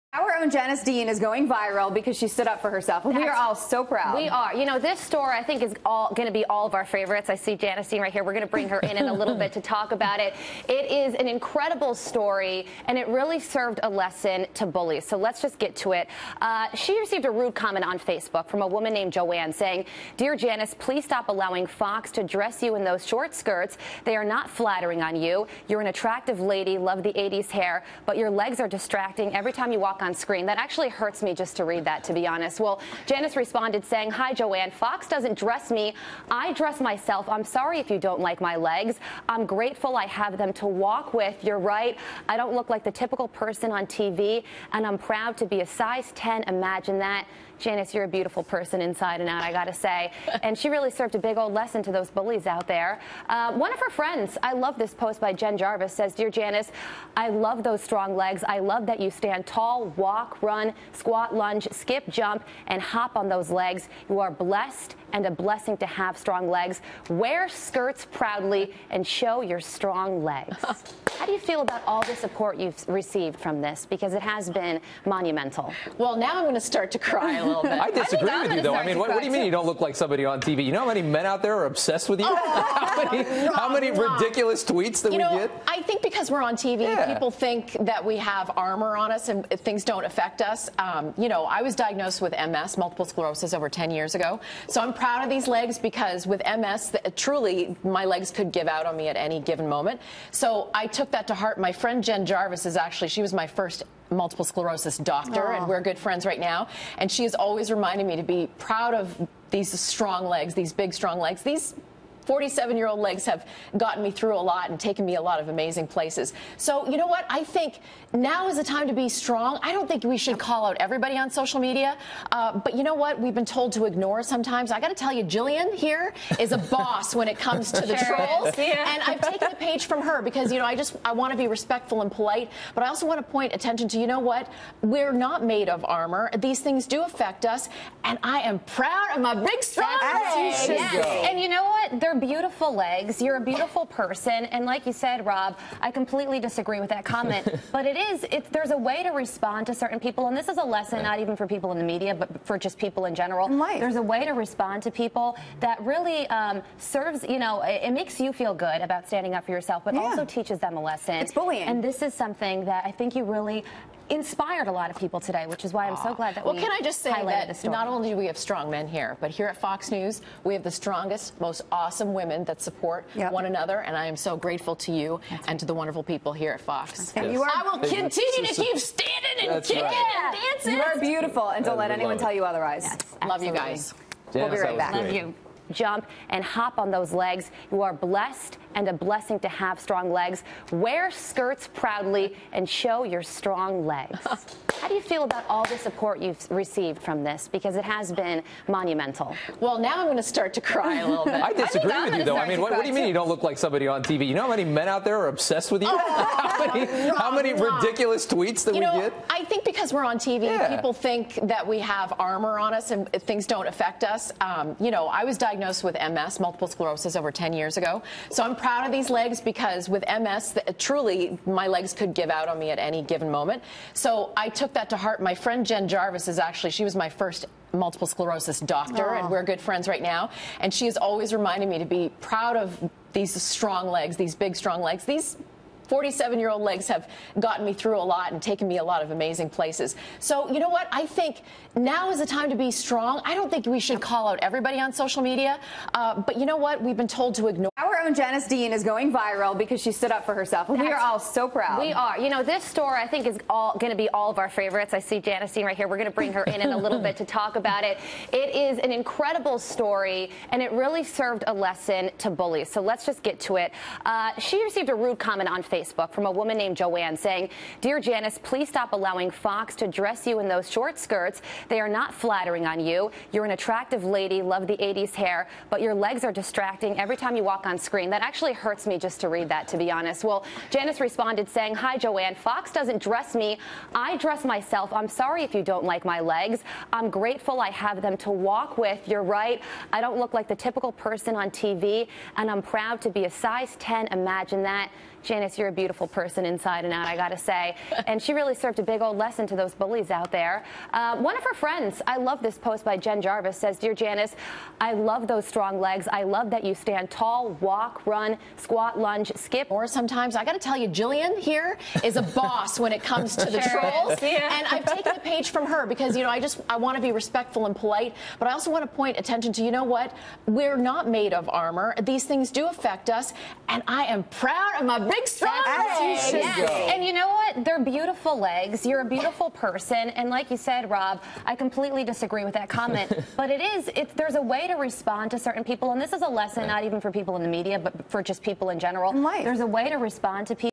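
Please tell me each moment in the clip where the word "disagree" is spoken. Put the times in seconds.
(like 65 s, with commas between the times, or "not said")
77 s, 146 s, 201 s, 332 s.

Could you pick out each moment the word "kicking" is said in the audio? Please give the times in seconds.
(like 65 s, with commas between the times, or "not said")
179 s.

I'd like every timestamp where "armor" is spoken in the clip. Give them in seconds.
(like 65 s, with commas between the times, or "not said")
88 s, 135 s, 212 s, 321 s.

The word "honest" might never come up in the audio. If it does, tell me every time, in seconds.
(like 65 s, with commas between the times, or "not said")
32 s, 279 s.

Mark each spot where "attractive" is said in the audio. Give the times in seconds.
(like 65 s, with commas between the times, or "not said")
25 s, 273 s.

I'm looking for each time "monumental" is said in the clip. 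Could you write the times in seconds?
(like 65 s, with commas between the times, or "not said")
75 s, 198 s.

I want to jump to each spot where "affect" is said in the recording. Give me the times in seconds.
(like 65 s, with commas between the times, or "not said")
90 s, 137 s, 213 s, 322 s.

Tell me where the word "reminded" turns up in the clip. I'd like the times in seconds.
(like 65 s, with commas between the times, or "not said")
107 s, 231 s.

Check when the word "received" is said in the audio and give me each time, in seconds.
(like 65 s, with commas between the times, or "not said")
16 s, 72 s, 196 s, 264 s.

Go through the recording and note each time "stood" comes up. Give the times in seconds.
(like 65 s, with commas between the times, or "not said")
2 s, 249 s.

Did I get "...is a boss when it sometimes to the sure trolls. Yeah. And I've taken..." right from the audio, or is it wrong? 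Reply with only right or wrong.
wrong.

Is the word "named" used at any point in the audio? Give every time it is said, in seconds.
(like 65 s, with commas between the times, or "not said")
18 s, 266 s.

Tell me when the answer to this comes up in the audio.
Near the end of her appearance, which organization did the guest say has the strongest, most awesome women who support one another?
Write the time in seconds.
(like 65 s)
169 s.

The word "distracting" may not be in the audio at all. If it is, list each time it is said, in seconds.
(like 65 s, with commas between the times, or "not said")
28 s, 276 s.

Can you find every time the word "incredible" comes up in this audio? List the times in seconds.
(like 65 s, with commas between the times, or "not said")
11 s, 258 s.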